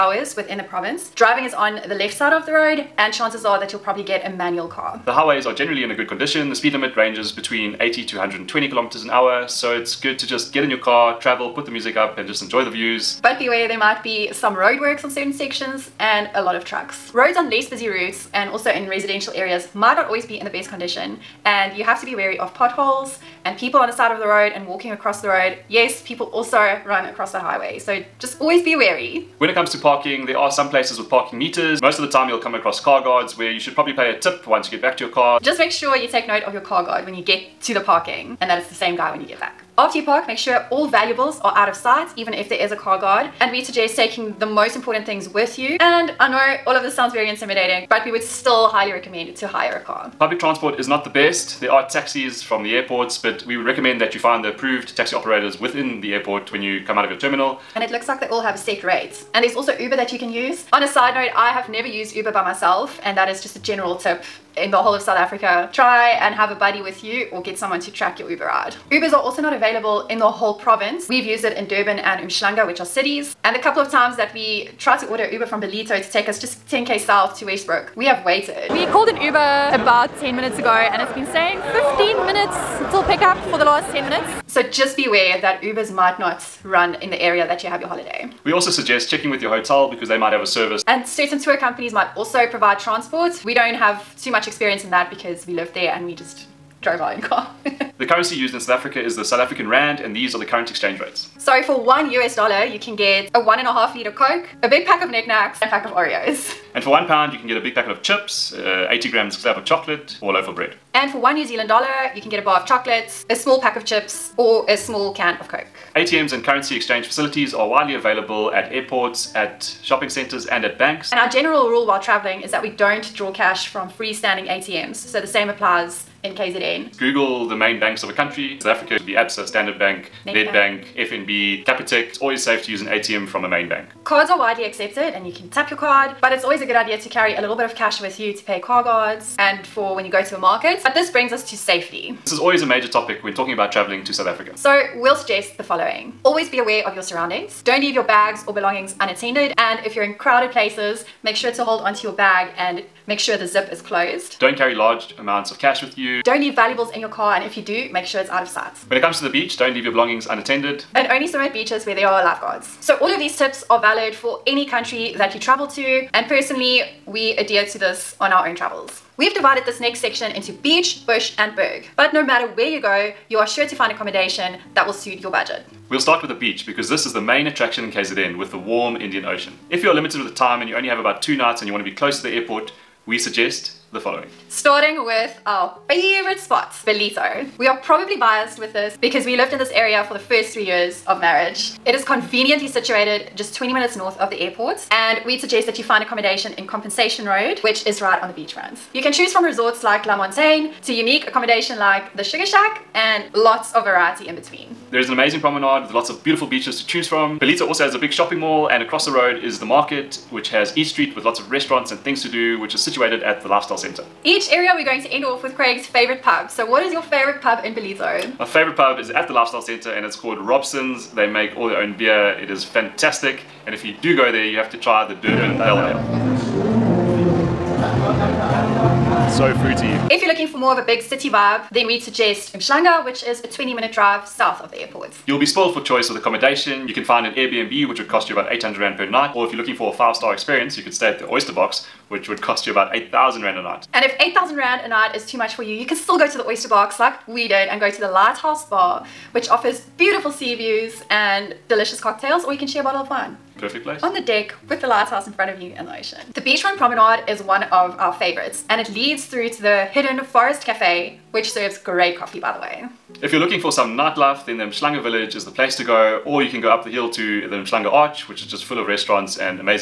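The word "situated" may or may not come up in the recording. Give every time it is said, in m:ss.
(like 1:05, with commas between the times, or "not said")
3:12, 3:32.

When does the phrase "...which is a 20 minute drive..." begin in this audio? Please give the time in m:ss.
3:53.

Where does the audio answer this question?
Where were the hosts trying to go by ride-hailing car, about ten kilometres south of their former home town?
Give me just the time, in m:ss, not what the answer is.
1:17.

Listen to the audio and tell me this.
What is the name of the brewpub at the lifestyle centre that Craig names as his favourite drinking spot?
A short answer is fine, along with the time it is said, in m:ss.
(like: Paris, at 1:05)
Robson's, at 3:40.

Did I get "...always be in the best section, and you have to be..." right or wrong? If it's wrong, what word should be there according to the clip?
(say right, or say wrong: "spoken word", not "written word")
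wrong: "condition", not "section".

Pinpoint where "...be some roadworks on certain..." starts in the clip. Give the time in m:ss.
0:14.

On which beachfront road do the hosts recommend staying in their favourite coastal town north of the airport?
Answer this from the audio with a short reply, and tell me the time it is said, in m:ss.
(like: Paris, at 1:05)
Compensation Road, at 3:16.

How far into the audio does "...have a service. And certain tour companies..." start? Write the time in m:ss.
1:30.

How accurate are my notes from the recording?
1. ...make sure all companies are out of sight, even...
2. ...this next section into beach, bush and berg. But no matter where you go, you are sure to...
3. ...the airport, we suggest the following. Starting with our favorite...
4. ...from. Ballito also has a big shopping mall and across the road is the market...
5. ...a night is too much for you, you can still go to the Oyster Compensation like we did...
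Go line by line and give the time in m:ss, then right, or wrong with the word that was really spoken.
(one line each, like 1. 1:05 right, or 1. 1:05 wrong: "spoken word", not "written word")
1. 0:40 wrong: "valuables", not "companies"
2. 2:49 right
3. 3:02 right
4. 3:27 right
5. 4:04 wrong: "Box", not "Compensation".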